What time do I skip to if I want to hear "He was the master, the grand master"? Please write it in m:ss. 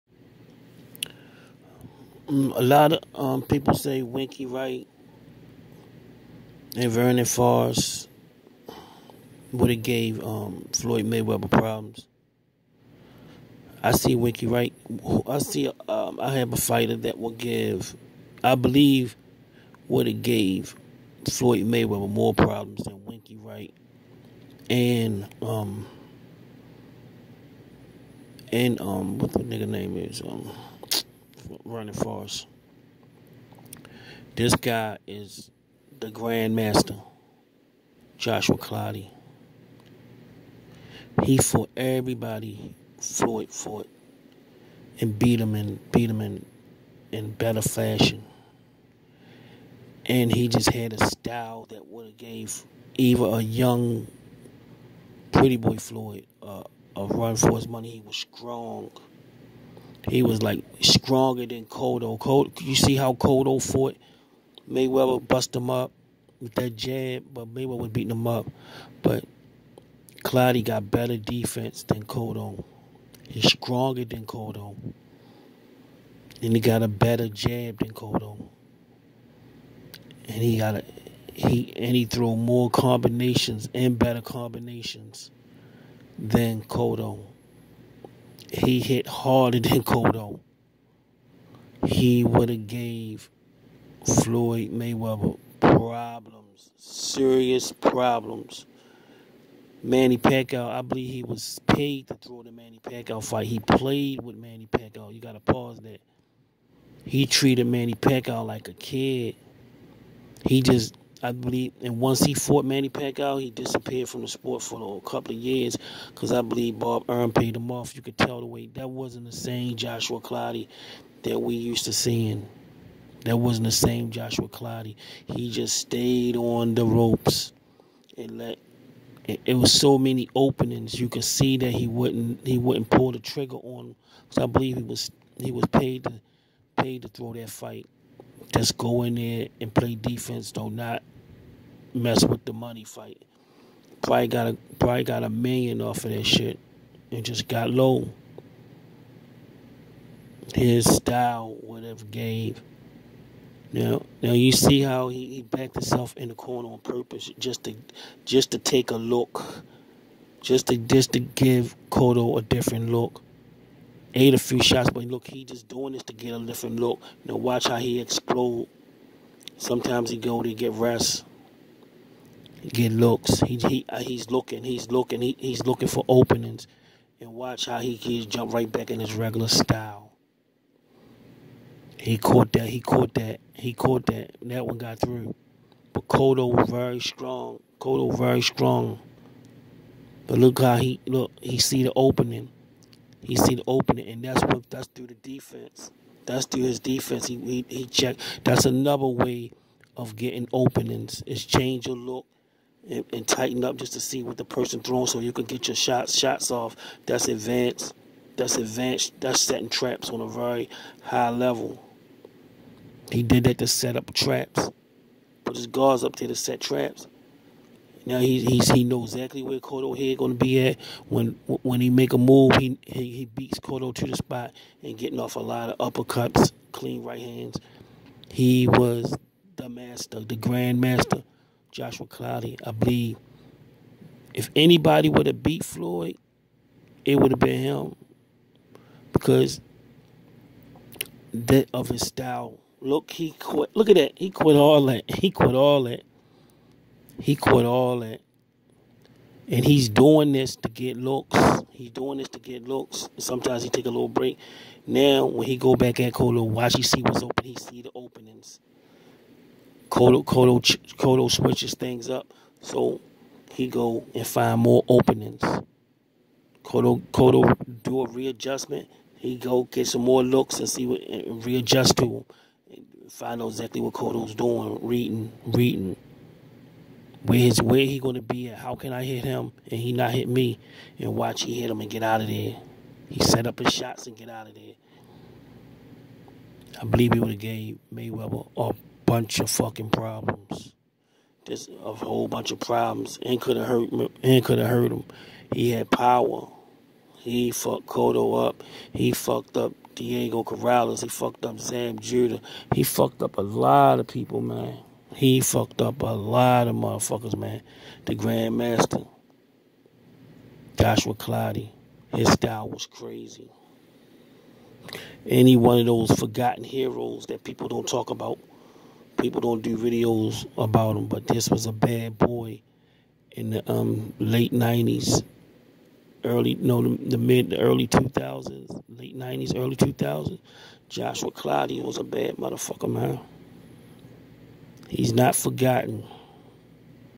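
3:48.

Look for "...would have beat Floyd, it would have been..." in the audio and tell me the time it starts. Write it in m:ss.
3:55.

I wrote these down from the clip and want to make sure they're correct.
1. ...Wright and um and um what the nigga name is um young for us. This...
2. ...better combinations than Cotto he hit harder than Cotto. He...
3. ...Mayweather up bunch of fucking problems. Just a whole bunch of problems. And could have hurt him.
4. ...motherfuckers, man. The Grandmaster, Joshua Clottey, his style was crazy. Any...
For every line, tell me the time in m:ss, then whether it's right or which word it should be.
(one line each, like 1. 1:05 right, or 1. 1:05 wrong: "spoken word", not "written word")
1. 0:23 wrong: "running", not "young"
2. 1:23 right
3. 4:47 right
4. 5:06 right.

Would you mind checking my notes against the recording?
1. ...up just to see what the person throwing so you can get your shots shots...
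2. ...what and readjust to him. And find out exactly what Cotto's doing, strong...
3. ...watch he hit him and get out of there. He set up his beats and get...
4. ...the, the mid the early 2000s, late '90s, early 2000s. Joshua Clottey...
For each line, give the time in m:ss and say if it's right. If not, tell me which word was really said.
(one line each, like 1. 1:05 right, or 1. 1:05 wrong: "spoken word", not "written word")
1. 3:23 right
2. 4:30 wrong: "reading", not "strong"
3. 4:41 wrong: "shots", not "beats"
4. 5:26 right.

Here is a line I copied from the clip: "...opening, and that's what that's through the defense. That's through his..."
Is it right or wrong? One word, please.
right.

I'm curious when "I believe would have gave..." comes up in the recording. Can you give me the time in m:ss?
0:18.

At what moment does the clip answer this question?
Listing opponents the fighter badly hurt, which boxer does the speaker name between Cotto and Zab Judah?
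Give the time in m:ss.
4:59.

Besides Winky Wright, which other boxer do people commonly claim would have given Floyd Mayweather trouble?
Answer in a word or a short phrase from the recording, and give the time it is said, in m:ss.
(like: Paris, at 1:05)
Vernon Forrest, at 0:06.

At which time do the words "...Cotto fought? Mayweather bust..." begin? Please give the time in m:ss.
1:03.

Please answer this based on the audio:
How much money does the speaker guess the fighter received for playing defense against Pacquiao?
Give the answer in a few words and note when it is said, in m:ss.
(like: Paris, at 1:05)
a million, at 2:25.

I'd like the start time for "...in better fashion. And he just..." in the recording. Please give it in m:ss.
0:47.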